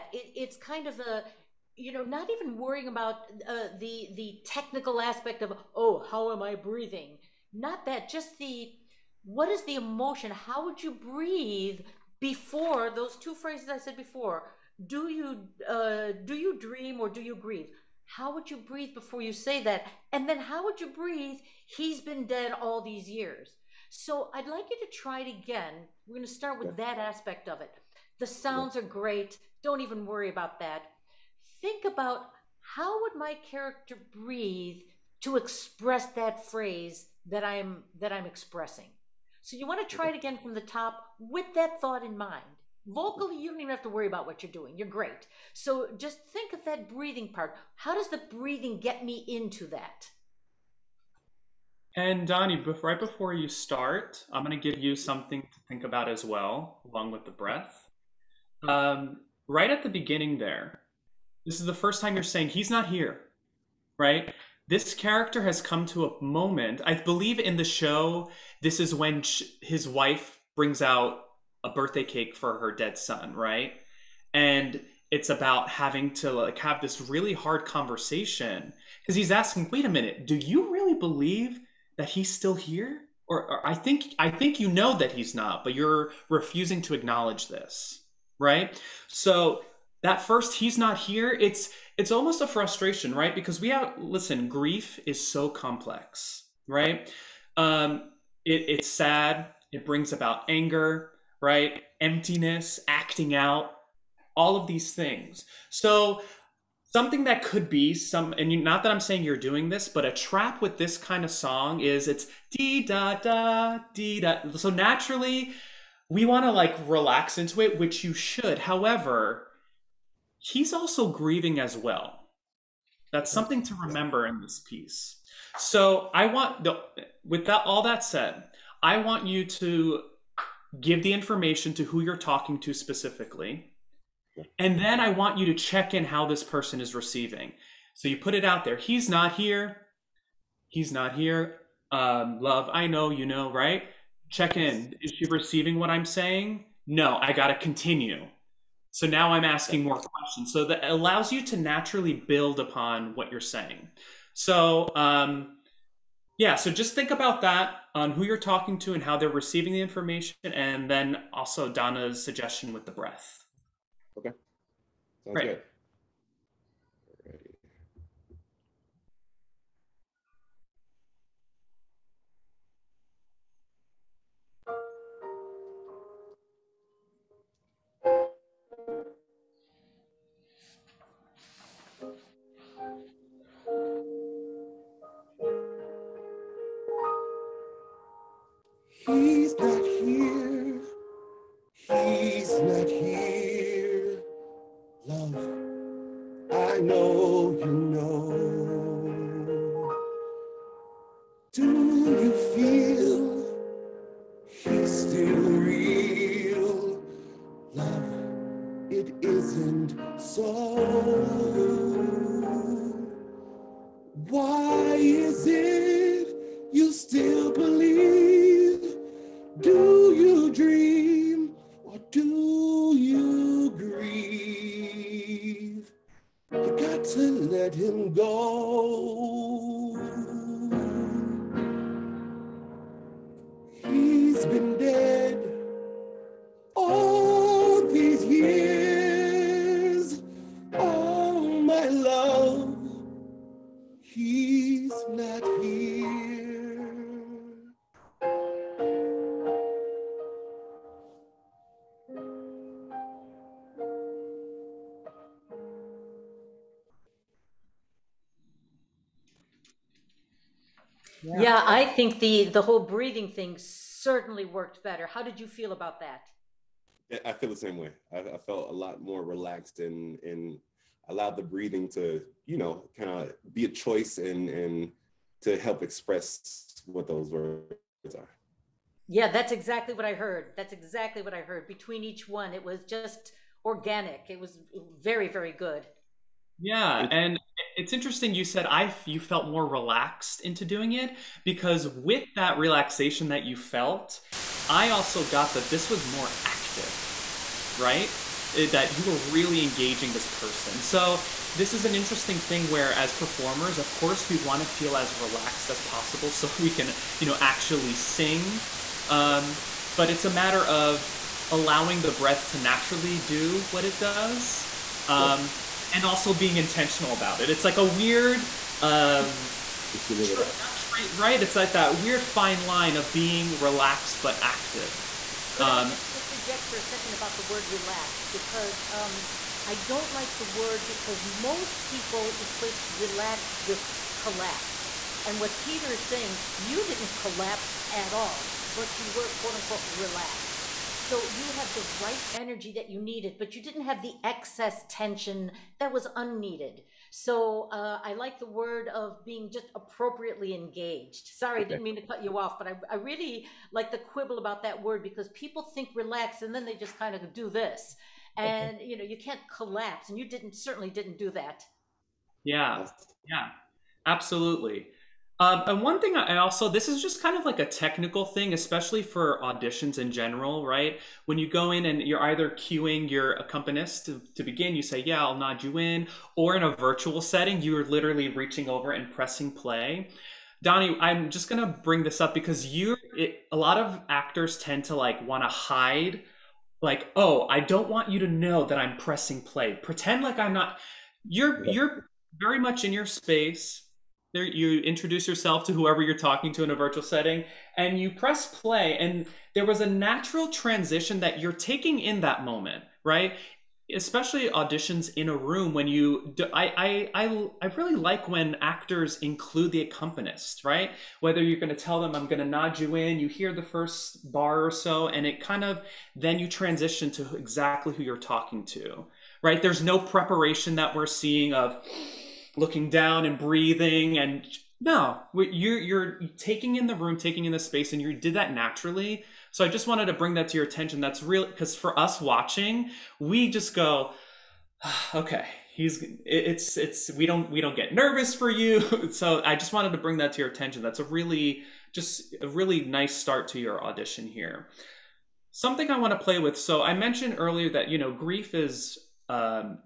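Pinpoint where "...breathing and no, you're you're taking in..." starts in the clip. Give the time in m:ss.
7:03.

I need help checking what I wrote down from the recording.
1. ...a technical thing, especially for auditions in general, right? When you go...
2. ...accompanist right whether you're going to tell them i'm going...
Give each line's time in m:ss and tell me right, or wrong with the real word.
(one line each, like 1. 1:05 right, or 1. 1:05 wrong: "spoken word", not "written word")
1. 6:07 right
2. 6:49 right.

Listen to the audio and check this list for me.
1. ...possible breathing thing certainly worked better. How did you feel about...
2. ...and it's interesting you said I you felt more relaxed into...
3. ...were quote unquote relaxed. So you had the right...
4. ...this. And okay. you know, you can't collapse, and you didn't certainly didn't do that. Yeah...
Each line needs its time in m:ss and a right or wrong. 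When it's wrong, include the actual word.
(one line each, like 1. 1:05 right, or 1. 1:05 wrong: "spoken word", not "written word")
1. 4:22 wrong: "whole", not "possible"
2. 4:47 right
3. 5:39 right
4. 5:57 right.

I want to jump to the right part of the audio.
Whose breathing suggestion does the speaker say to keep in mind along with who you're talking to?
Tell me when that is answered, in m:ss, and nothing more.
2:41.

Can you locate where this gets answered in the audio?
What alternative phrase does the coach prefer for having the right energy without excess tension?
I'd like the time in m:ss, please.
5:49.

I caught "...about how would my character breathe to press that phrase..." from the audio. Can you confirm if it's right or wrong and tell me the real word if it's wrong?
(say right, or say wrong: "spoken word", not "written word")
wrong: "express", not "press".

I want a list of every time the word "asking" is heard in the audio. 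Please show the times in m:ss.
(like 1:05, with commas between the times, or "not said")
1:19, 2:29.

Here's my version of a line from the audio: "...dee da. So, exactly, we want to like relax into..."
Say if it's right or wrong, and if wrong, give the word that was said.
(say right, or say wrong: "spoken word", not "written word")
wrong: "naturally", not "exactly".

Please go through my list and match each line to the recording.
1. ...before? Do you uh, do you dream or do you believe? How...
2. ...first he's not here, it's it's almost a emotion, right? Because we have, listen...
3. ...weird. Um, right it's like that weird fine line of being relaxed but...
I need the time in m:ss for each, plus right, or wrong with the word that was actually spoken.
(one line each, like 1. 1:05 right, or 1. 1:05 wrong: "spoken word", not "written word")
1. 0:13 wrong: "grieve", not "believe"
2. 1:30 wrong: "frustration", not "emotion"
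3. 5:17 right.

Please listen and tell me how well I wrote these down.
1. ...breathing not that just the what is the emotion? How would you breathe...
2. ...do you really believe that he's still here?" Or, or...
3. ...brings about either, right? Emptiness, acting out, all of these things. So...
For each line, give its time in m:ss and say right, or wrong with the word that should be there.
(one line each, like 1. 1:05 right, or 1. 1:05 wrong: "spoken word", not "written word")
1. 0:06 right
2. 1:20 right
3. 1:39 wrong: "anger", not "either".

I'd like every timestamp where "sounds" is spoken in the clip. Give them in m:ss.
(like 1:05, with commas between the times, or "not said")
0:28, 2:44.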